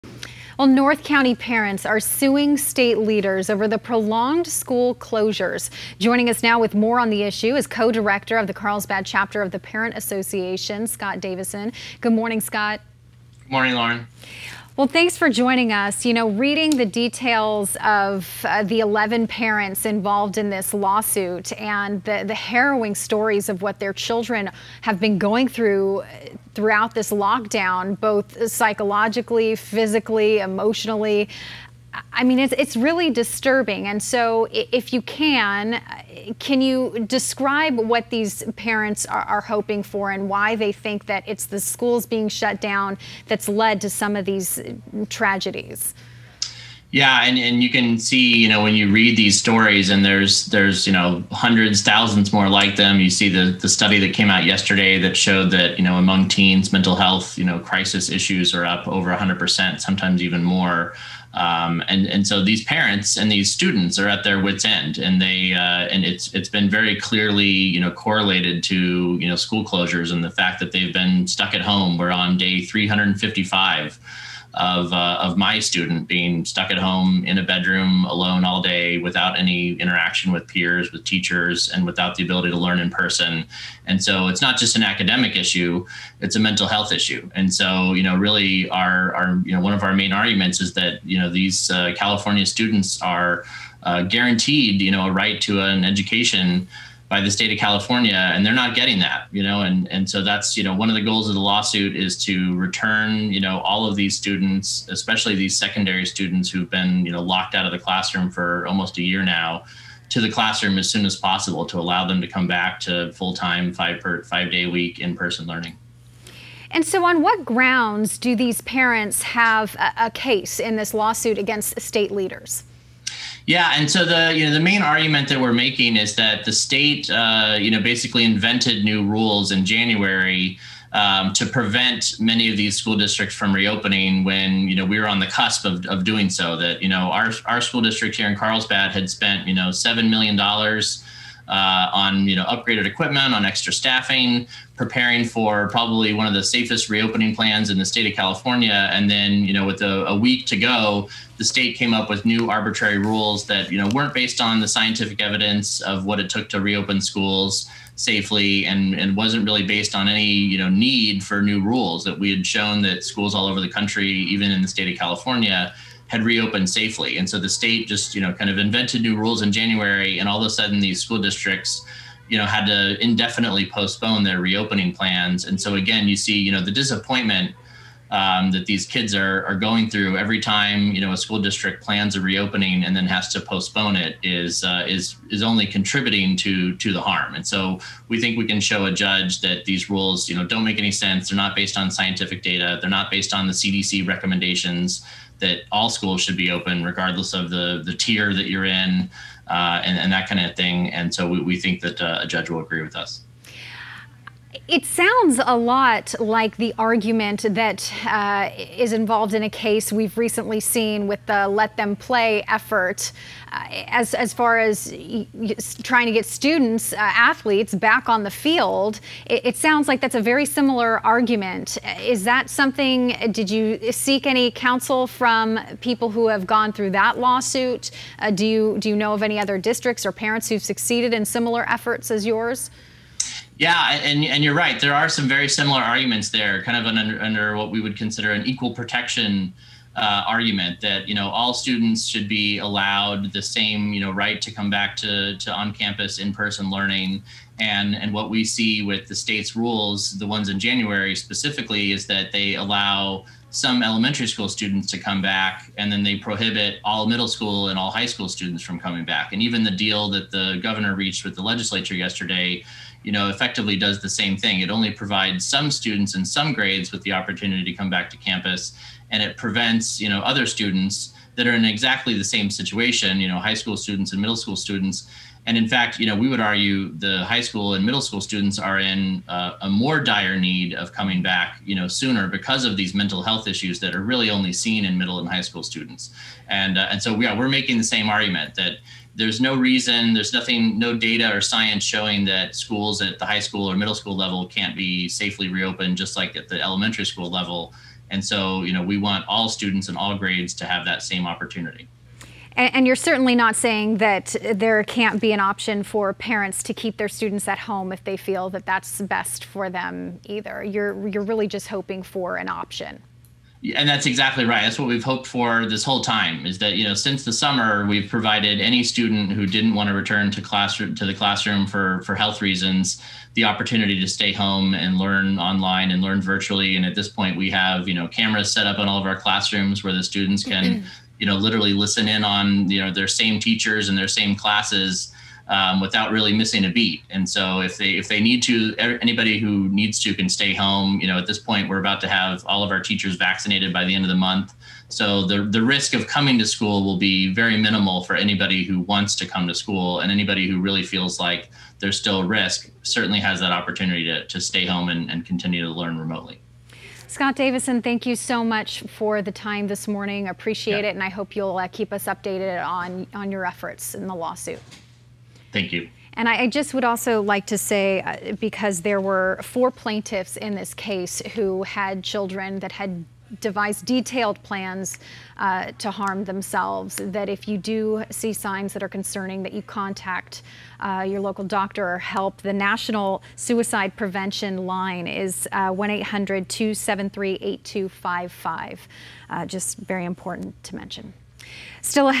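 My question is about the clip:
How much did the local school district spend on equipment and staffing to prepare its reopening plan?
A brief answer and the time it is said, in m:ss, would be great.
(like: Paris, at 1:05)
$7 million, at 2:19.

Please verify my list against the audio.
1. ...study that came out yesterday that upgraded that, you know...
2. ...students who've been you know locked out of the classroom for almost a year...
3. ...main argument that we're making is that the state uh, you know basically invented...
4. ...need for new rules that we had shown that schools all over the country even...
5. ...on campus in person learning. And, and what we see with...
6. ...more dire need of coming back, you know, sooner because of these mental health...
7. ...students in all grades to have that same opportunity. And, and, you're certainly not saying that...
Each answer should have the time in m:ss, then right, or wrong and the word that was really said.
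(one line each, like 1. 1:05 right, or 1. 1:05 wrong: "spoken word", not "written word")
1. 0:53 wrong: "showed", not "upgraded"
2. 1:46 right
3. 2:04 right
4. 2:40 right
5. 4:05 right
6. 4:39 right
7. 4:59 right.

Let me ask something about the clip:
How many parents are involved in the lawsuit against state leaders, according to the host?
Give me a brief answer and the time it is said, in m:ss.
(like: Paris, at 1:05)
11, at 0:18.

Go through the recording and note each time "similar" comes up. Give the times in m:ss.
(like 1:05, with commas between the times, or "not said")
3:40, 3:51, 3:55.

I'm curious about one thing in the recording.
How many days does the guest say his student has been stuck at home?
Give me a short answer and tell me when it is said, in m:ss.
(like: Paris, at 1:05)
355, at 1:12.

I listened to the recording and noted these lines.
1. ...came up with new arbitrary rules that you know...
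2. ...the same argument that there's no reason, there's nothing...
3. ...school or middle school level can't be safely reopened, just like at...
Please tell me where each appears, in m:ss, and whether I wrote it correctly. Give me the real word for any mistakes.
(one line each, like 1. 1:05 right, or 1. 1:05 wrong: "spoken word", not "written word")
1. 2:31 right
2. 4:47 right
3. 4:53 right.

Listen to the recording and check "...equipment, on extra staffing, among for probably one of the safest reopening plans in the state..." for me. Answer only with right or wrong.
wrong.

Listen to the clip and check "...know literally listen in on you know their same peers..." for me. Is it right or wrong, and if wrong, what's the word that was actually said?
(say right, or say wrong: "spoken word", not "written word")
wrong: "teachers", not "peers".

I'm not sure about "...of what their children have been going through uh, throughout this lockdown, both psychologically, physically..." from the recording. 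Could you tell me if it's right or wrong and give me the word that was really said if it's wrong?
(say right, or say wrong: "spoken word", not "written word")
right.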